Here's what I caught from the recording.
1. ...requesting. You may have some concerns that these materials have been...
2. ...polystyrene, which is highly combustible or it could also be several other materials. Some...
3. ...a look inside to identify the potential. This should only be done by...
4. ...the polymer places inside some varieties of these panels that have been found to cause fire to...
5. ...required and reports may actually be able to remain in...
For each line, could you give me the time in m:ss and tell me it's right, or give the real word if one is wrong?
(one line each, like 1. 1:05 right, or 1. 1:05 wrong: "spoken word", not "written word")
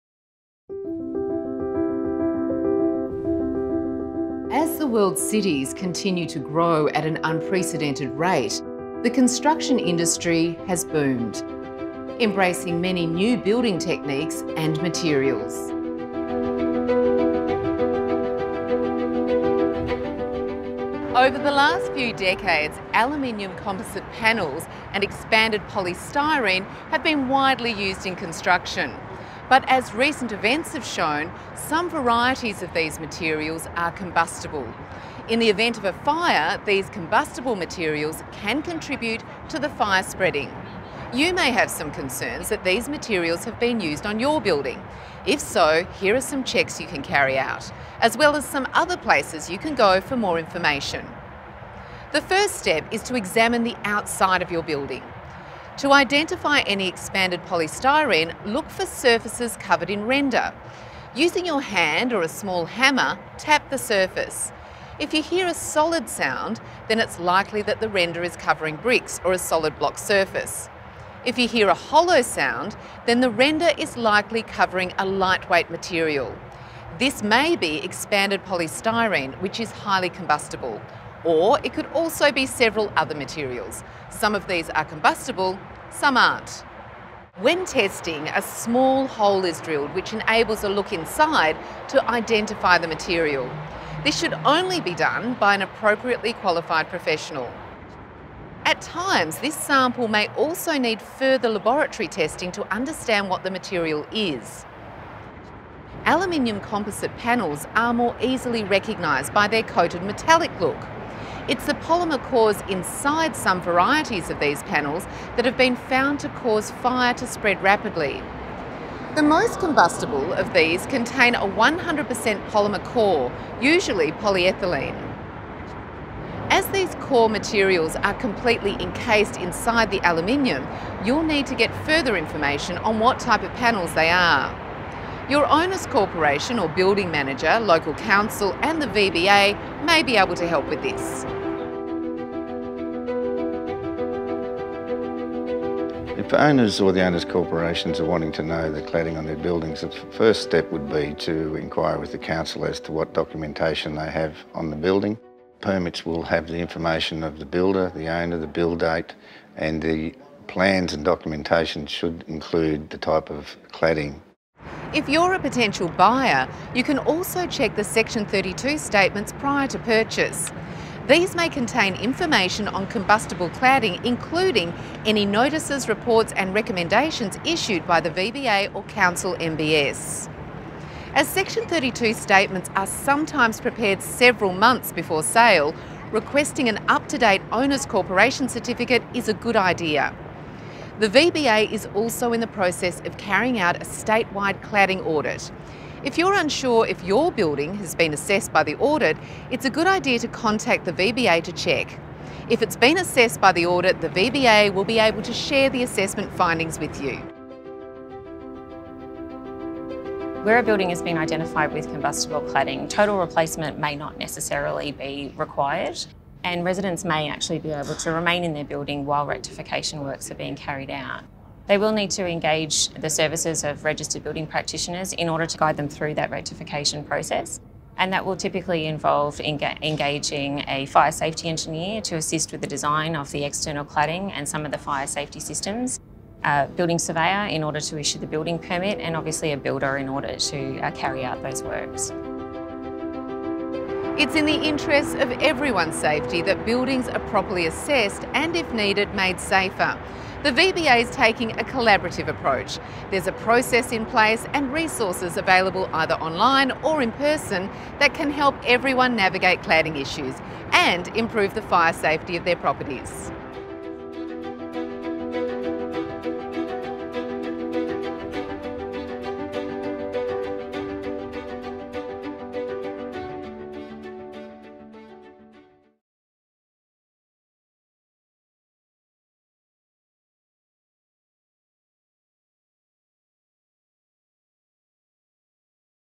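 1. 0:40 wrong: "spreading", not "requesting"
2. 1:18 right
3. 1:30 wrong: "material", not "potential"
4. 1:51 wrong: "cores", not "places"
5. 3:35 wrong: "residents", not "reports".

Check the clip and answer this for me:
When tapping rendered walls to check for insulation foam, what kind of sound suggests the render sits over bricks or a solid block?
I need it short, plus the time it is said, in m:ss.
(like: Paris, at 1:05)
solid sound, at 1:05.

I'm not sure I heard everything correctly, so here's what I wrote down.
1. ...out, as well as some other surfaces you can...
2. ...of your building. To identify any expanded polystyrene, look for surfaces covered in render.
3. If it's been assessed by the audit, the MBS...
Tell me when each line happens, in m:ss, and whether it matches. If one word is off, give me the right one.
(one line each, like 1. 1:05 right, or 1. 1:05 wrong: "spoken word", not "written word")
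1. 0:47 wrong: "places", not "surfaces"
2. 0:54 right
3. 3:22 wrong: "VBA", not "MBS".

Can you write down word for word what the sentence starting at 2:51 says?
These may contain information on combustible cladding, including any notices, reports and recommendations issued by the VBA or Council MBS.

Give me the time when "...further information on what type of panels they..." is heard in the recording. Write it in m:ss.
2:11.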